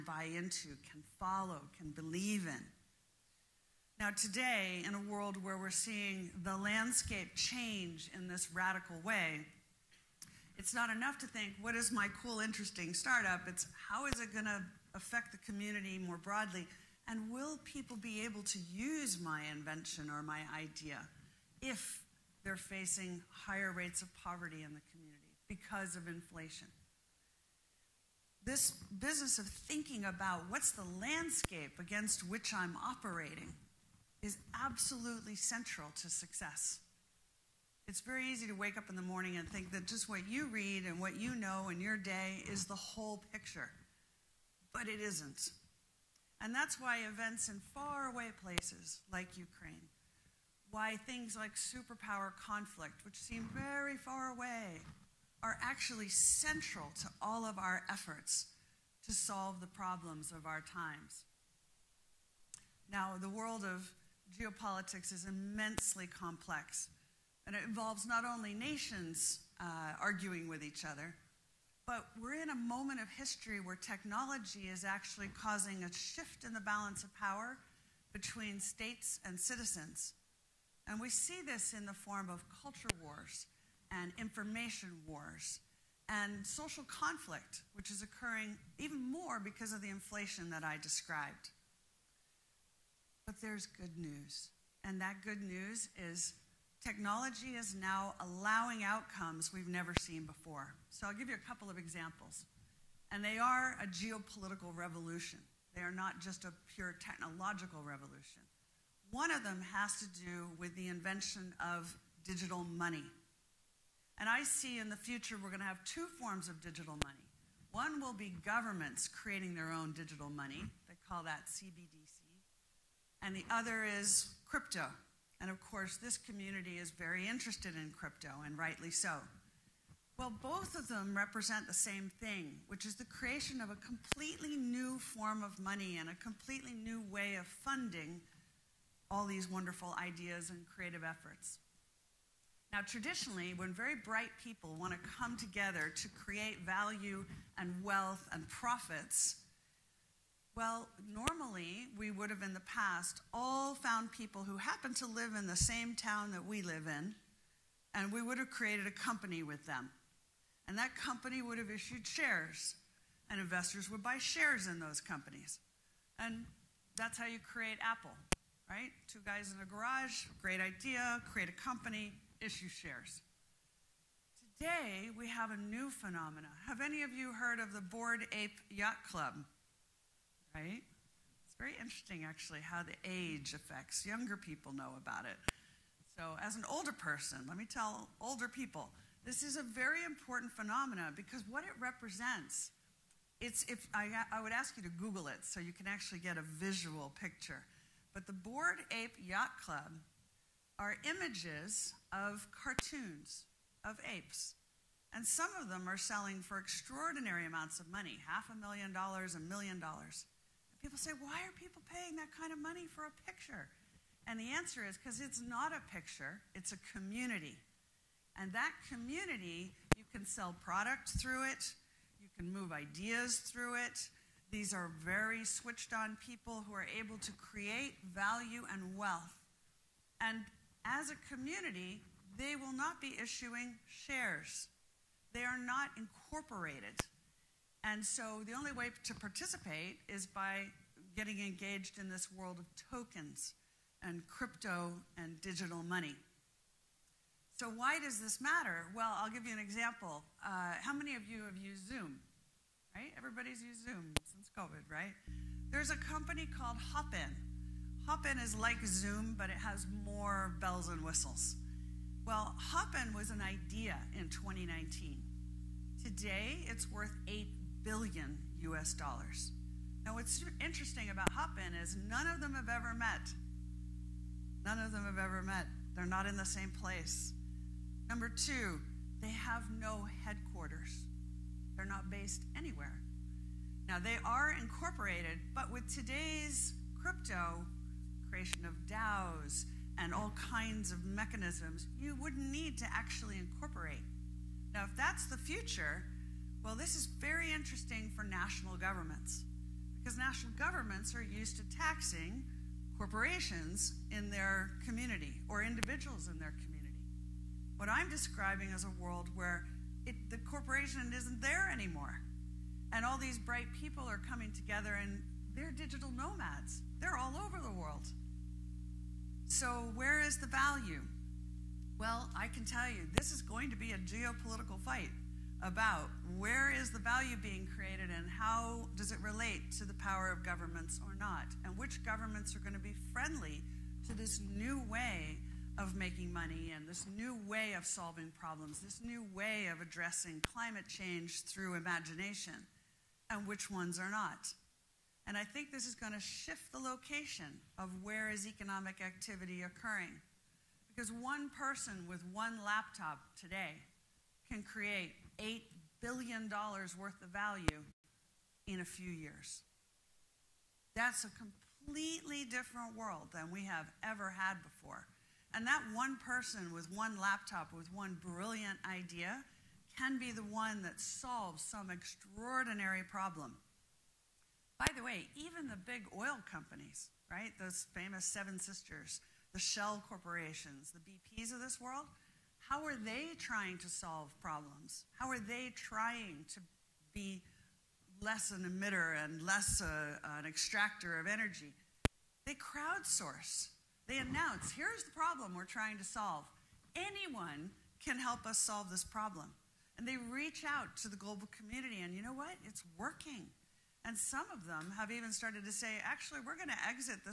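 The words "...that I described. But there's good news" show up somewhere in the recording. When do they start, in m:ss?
1:30.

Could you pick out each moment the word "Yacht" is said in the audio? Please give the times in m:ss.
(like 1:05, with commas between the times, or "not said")
2:58, 3:19.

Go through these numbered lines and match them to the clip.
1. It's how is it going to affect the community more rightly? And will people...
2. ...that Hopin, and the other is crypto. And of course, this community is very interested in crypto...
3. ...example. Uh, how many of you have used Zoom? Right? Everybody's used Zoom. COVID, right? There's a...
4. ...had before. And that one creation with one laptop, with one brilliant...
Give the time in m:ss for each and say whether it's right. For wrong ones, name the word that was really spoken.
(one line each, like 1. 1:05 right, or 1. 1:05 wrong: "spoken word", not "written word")
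1. 0:13 wrong: "broadly", not "rightly"
2. 2:01 wrong: "CBDC", not "Hopin"
3. 4:09 right
4. 6:04 wrong: "person", not "creation".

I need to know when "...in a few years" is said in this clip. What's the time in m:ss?
5:58.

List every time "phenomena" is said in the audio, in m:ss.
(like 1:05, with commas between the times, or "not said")
2:55, 3:10.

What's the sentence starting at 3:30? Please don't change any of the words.
People say, why are people paying that kind of money for a picture?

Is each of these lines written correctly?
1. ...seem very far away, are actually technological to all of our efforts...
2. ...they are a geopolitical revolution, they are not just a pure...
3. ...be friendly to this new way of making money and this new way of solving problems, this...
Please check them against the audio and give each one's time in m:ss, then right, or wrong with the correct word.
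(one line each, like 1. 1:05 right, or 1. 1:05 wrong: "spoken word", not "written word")
1. 0:53 wrong: "central", not "technological"
2. 1:43 right
3. 5:32 right.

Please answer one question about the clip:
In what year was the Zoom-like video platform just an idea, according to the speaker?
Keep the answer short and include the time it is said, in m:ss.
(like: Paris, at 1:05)
2019, at 4:24.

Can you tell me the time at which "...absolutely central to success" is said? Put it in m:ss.
0:34.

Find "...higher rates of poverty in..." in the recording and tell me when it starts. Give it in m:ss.
0:23.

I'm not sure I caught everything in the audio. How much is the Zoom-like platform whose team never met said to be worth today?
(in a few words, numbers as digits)
$8 billion.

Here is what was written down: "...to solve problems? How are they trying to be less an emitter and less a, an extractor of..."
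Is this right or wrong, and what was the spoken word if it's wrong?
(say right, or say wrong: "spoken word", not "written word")
right.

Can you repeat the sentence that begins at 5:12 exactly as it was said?
And all these bright people are coming together and they're digital nomads.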